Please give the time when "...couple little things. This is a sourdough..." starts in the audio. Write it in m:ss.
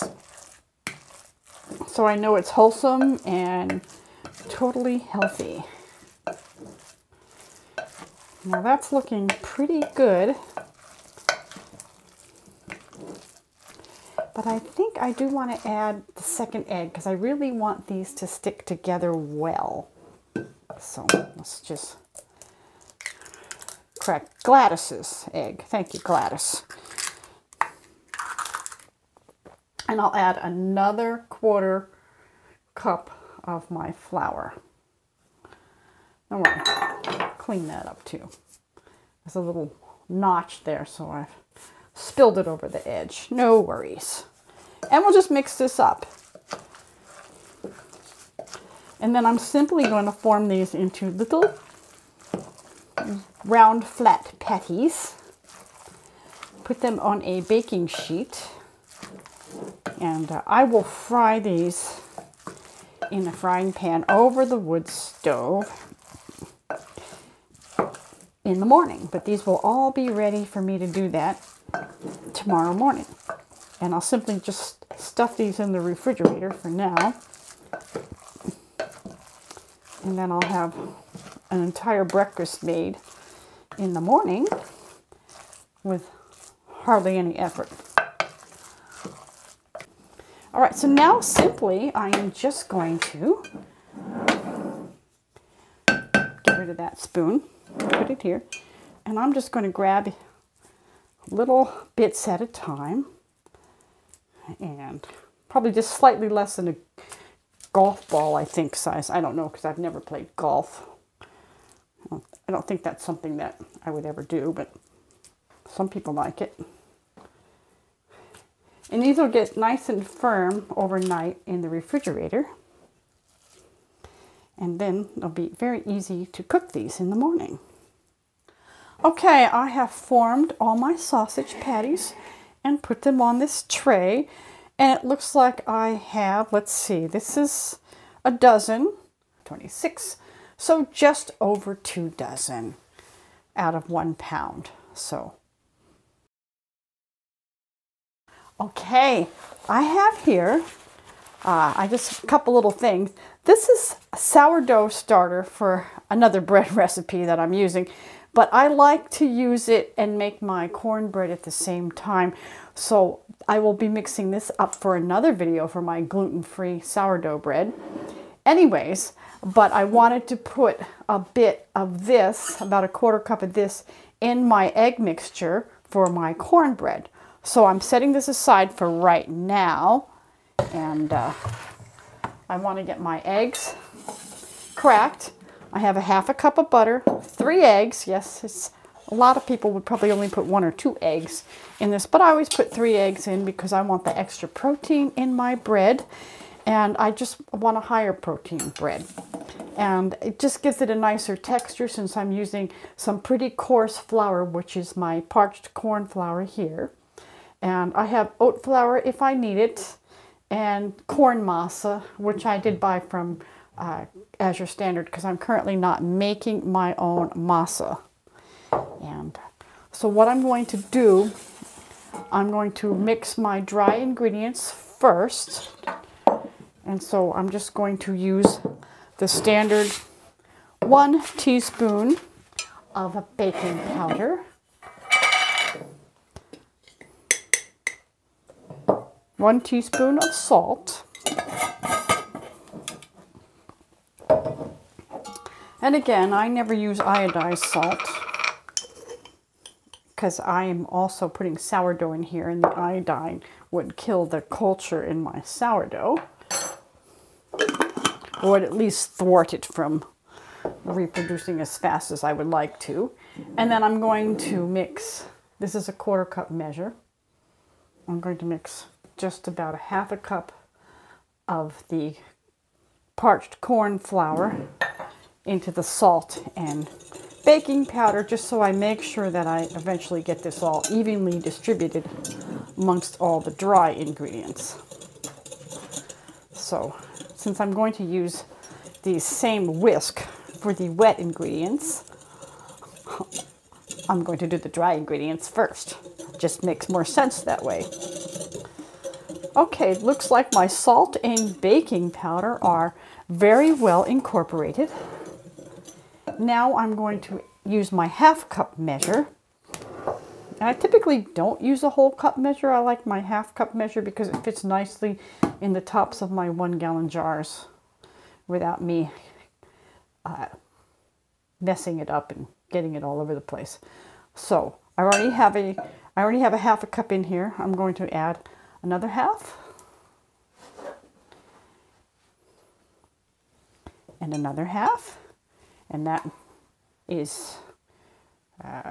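2:32.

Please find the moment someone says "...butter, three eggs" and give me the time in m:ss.
3:06.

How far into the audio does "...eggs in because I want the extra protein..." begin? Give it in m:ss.
3:12.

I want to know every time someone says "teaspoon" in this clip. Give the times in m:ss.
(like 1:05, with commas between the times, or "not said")
3:51, 3:59.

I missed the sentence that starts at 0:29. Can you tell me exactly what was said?
And I'll add another quarter cup of my flour.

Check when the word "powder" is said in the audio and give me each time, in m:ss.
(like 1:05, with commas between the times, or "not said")
3:53, 4:37, 5:02.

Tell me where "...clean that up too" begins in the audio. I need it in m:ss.
0:37.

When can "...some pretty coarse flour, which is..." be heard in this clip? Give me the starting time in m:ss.
3:22.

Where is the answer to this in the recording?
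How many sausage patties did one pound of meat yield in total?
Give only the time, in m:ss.
2:19.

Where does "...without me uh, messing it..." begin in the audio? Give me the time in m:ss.
5:18.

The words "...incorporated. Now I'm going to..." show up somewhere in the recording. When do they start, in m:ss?
5:04.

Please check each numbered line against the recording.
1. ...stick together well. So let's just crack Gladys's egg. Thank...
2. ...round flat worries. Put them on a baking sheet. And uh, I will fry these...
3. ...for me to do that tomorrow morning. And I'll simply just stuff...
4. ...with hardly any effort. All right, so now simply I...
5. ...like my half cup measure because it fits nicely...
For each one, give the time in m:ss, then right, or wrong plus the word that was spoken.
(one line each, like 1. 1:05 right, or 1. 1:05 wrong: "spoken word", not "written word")
1. 0:18 right
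2. 0:53 wrong: "patties", not "worries"
3. 1:10 right
4. 1:25 right
5. 5:12 right.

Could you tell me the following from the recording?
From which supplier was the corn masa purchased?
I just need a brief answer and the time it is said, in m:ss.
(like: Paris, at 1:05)
Azure Standard, at 3:34.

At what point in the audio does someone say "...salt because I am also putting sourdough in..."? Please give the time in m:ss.
4:07.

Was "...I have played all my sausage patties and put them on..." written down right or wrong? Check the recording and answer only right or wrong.
wrong.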